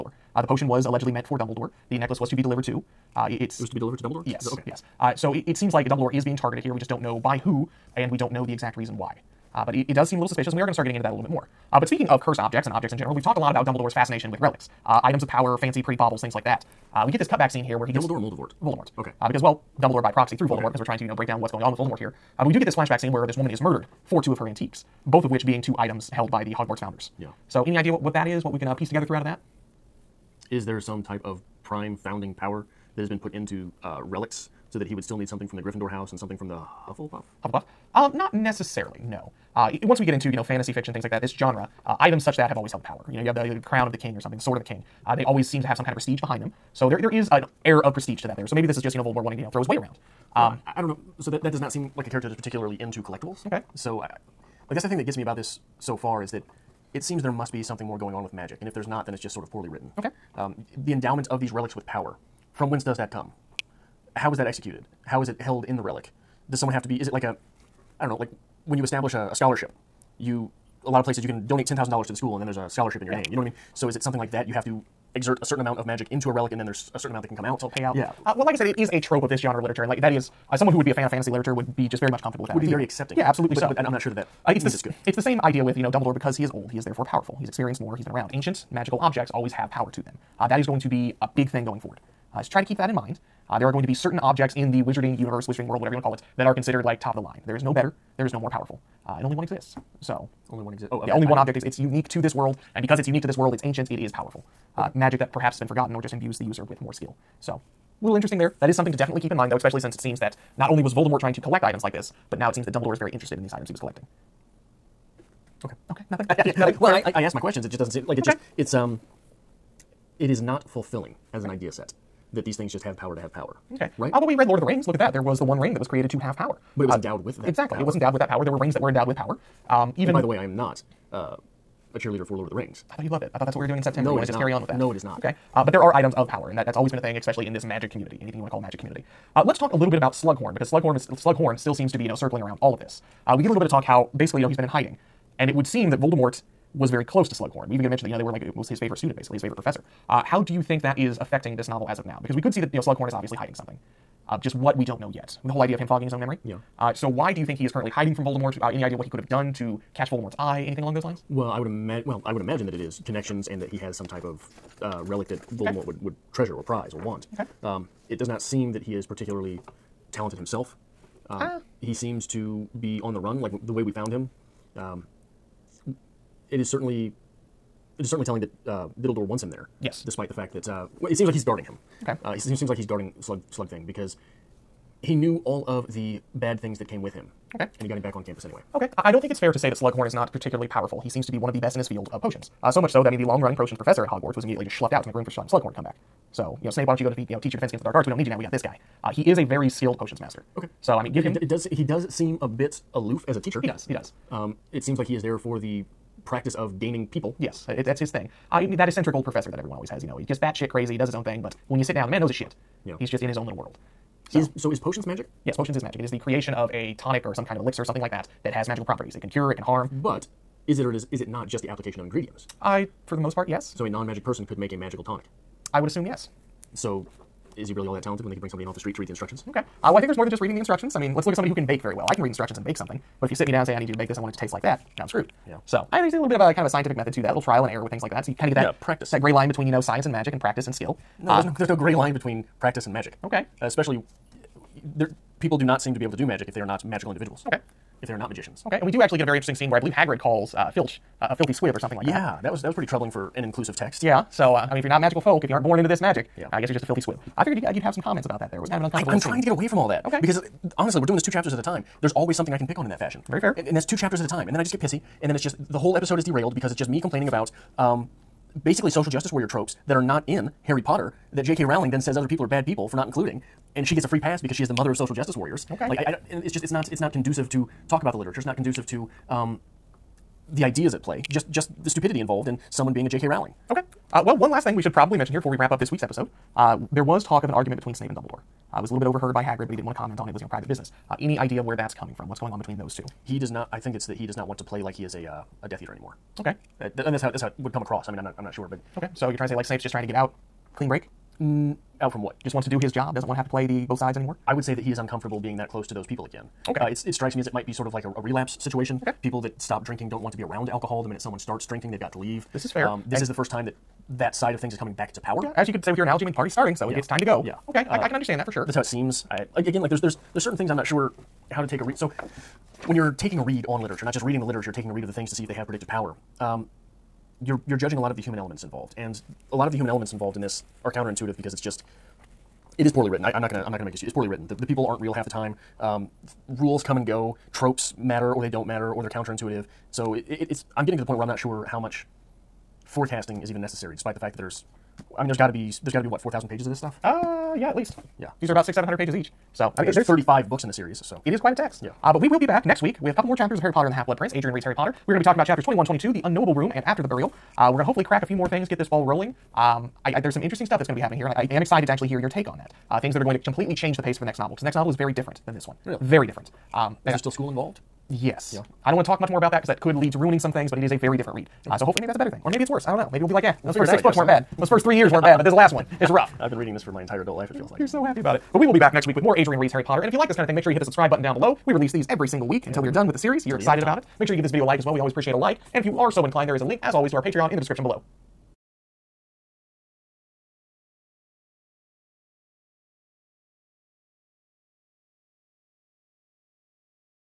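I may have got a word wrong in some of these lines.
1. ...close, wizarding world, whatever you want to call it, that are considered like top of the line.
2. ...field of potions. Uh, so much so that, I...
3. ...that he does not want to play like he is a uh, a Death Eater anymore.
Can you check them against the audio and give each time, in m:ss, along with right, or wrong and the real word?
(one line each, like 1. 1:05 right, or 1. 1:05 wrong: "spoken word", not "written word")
1. 1:35 wrong: "universe", not "close"
2. 3:11 right
3. 4:54 right.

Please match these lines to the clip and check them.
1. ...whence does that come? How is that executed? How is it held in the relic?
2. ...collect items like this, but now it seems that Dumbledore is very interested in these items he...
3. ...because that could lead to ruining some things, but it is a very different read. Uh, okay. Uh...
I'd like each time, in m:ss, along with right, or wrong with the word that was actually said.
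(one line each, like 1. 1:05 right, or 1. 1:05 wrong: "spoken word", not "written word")
1. 1:02 right
2. 1:51 right
3. 6:09 right.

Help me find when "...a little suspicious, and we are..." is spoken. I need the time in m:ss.
0:10.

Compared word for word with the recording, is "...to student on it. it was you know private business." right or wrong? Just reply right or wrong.
wrong.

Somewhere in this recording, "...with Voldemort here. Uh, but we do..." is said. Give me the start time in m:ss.
0:21.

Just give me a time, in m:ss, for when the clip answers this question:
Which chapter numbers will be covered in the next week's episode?
5:55.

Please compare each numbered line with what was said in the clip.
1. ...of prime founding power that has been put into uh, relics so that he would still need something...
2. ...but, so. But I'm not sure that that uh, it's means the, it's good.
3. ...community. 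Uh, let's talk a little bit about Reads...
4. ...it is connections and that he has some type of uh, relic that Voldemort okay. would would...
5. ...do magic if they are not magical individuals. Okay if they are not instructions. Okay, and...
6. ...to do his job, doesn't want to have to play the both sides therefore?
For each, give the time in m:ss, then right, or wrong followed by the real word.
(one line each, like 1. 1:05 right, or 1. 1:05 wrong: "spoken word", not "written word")
1. 0:31 right
2. 1:23 right
3. 2:18 wrong: "Slughorn", not "Reads"
4. 2:42 right
5. 4:06 wrong: "magicians", not "instructions"
6. 5:02 wrong: "anymore", not "therefore".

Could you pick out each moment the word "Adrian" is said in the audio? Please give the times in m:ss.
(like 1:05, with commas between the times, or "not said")
5:54, 6:19.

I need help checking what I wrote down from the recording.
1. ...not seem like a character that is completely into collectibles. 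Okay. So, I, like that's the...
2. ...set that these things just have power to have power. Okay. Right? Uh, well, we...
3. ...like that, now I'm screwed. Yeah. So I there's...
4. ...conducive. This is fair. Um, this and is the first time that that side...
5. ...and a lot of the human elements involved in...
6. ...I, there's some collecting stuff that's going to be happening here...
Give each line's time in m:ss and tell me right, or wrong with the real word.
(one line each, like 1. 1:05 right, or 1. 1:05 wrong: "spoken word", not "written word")
1. 0:51 wrong: "particularly", not "completely"
2. 2:01 right
3. 3:54 right
4. 5:12 wrong: "leave", not "conducive"
5. 5:28 right
6. 6:00 wrong: "interesting", not "collecting".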